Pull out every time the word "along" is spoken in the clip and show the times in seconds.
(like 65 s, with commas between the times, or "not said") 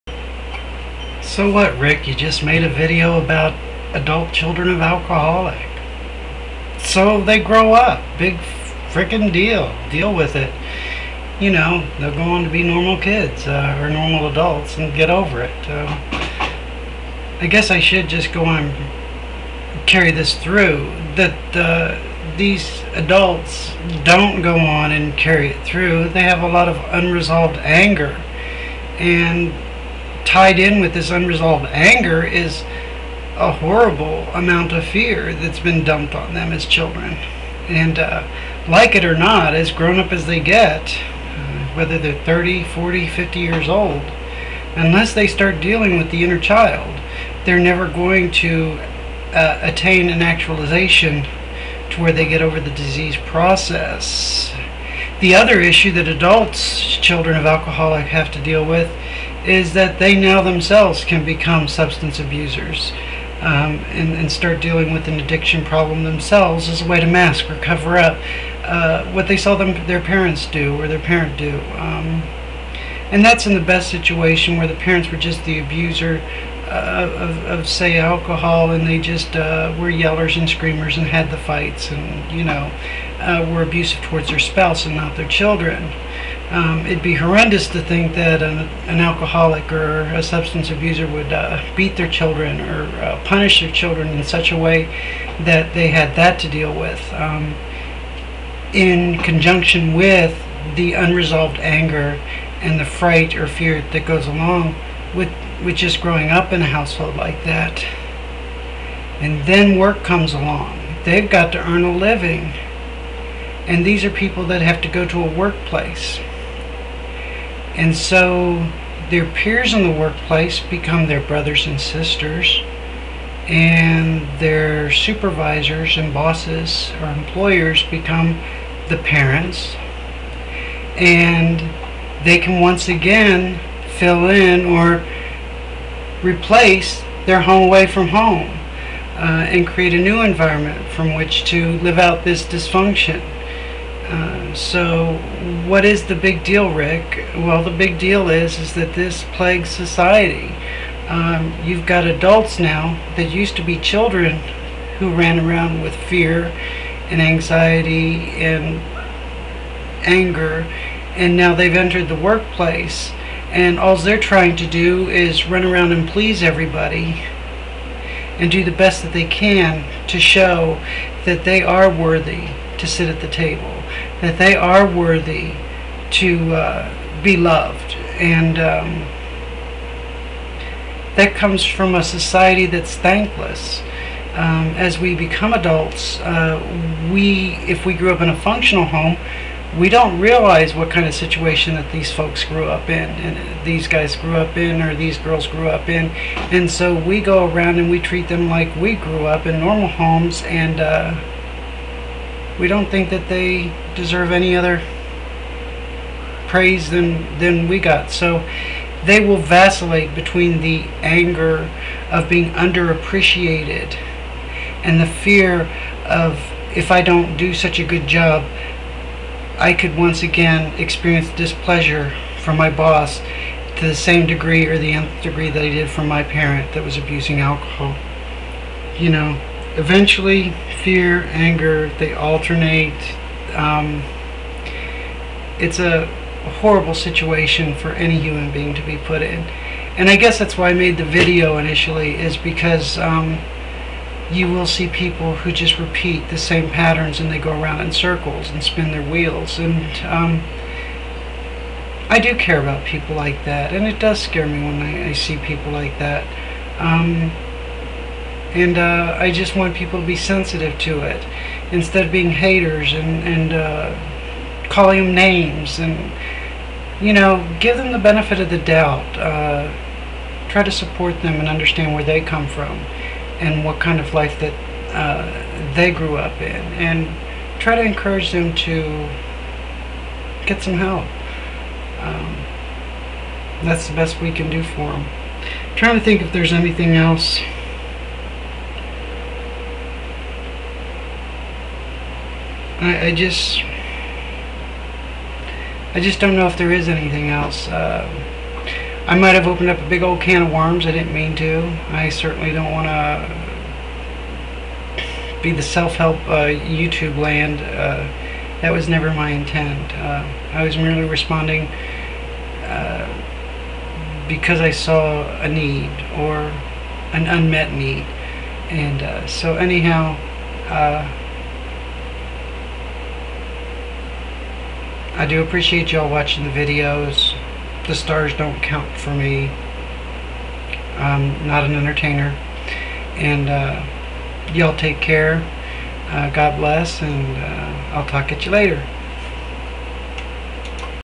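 104 s, 110 s.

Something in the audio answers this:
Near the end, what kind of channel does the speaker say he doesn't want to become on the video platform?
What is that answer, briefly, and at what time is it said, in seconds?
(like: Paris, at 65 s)
The self-help, at 305 s.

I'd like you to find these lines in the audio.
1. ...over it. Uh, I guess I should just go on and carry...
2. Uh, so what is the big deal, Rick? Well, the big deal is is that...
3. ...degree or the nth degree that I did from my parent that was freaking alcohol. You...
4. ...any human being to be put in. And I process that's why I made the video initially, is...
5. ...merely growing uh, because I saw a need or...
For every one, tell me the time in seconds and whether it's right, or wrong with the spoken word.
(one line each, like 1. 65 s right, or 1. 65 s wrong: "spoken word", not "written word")
1. 15 s right
2. 144 s right
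3. 224 s wrong: "abusing", not "freaking"
4. 237 s wrong: "guess", not "process"
5. 310 s wrong: "responding", not "growing".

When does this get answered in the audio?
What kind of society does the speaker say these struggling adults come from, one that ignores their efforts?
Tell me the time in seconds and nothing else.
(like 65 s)
182 s.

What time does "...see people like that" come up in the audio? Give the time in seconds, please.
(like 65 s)
255 s.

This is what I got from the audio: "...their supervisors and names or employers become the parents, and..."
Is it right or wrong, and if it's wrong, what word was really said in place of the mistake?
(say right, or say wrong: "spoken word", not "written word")
wrong: "bosses", not "names".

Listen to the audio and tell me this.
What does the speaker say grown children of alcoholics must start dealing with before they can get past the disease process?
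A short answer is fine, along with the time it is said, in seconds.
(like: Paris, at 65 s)
The inner child, at 46 s.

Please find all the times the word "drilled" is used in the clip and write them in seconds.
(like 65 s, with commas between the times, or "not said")
not said.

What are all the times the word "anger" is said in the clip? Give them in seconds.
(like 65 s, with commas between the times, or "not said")
27 s, 31 s, 101 s, 160 s, 211 s, 231 s.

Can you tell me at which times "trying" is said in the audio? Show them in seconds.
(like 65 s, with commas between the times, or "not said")
164 s, 285 s.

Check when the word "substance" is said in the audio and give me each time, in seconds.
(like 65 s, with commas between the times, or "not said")
61 s, 90 s.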